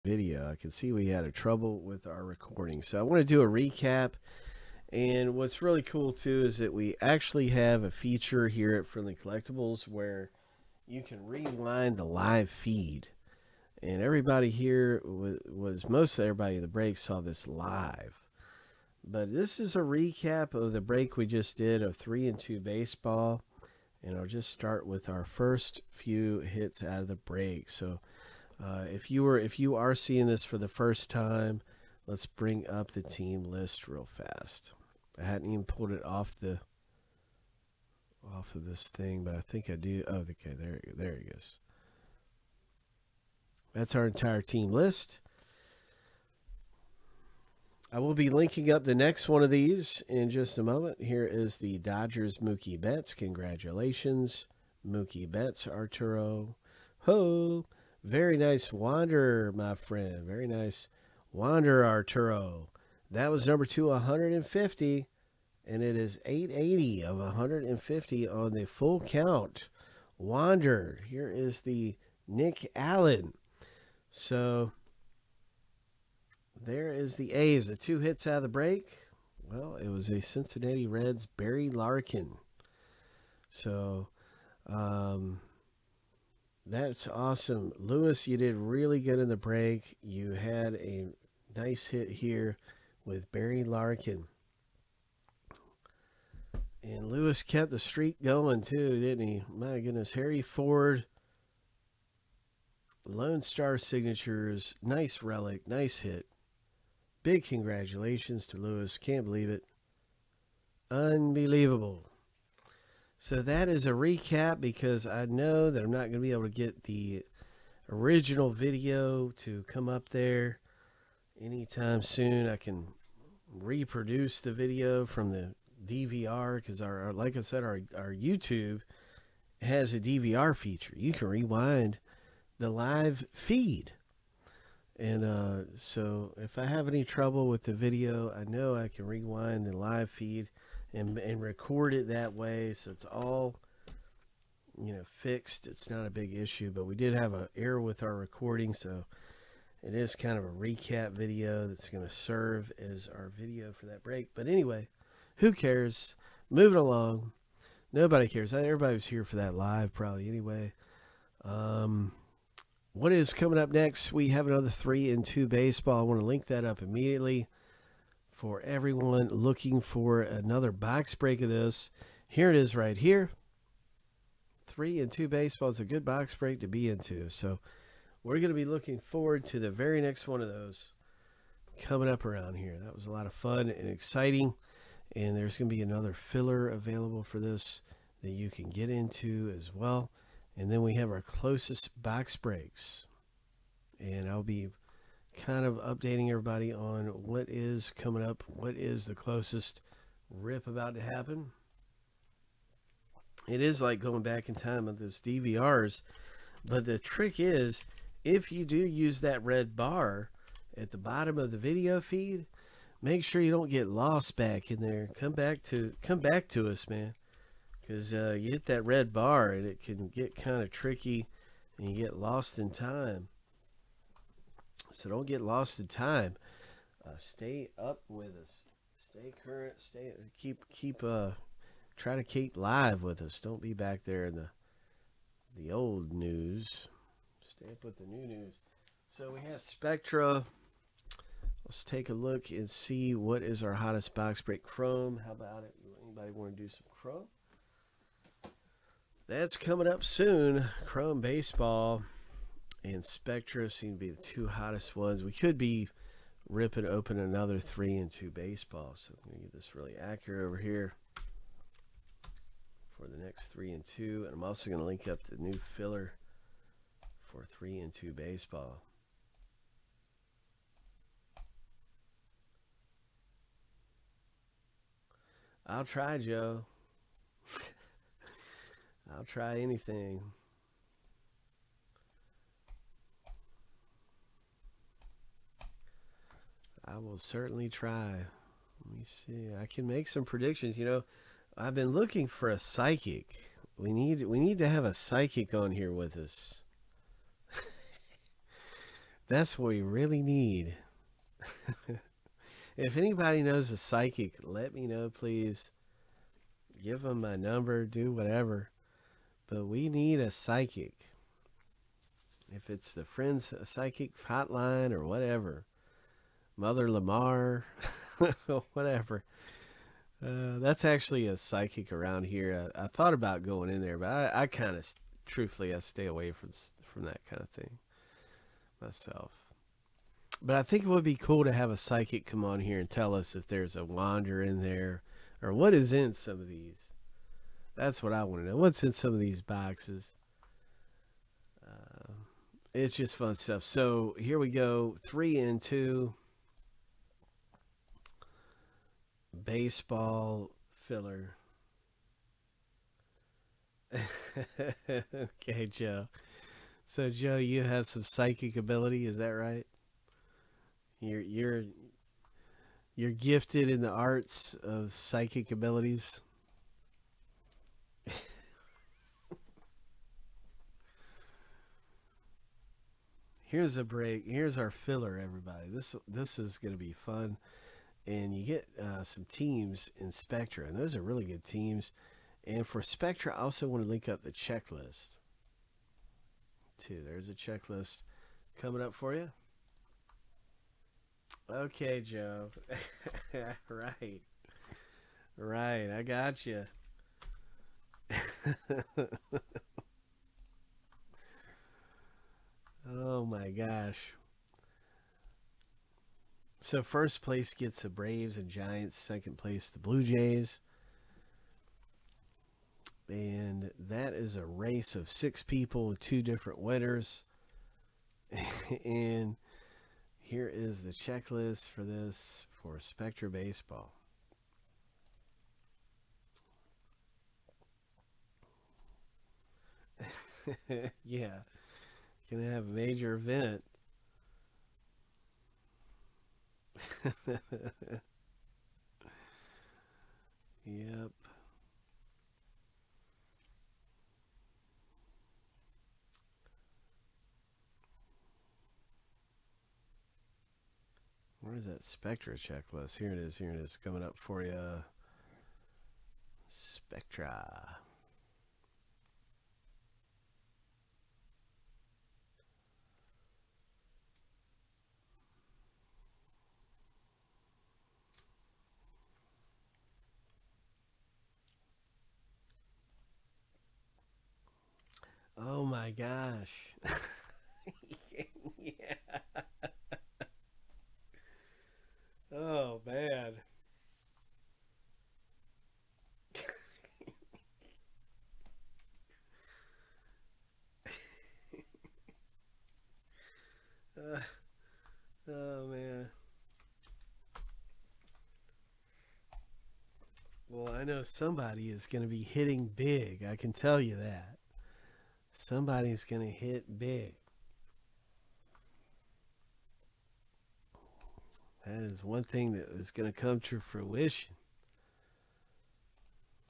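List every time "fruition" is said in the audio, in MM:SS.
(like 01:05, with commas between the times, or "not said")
08:33.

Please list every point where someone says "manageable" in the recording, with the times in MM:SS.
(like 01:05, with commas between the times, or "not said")
not said.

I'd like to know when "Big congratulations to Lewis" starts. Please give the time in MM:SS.
01:47.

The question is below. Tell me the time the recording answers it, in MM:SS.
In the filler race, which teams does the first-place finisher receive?
06:47.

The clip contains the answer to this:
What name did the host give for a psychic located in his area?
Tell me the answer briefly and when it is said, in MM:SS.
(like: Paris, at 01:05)
Mother Lamar, at 05:16.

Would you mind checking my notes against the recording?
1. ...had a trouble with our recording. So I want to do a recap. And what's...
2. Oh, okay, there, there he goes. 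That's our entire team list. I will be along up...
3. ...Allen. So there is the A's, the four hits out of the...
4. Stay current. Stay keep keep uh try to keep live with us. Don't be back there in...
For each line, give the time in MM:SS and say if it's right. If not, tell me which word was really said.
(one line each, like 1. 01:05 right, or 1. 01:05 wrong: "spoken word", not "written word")
1. 00:01 right
2. 00:40 wrong: "linking", not "along"
3. 01:12 wrong: "two", not "four"
4. 03:49 right.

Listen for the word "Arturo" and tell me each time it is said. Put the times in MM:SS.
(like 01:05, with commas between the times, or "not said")
00:55, 01:01.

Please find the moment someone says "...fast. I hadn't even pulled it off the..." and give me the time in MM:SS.
00:34.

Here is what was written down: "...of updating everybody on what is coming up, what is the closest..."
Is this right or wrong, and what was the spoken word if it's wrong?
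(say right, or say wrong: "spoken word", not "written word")
right.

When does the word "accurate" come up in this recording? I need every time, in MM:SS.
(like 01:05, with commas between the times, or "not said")
04:19.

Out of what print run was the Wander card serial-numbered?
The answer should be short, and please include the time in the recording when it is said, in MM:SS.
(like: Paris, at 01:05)
150, at 01:06.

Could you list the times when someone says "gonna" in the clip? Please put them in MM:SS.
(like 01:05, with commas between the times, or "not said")
04:19, 04:24, 07:12.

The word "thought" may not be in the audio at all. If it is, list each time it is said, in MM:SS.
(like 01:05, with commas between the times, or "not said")
05:22.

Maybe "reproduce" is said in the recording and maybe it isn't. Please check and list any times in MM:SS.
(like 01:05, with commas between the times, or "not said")
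02:03.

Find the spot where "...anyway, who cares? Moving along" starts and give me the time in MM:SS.
02:34.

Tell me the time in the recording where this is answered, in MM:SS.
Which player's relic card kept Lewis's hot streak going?
01:40.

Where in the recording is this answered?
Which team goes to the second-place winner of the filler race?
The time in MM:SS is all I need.
06:49.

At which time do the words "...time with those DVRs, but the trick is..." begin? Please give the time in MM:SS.
03:24.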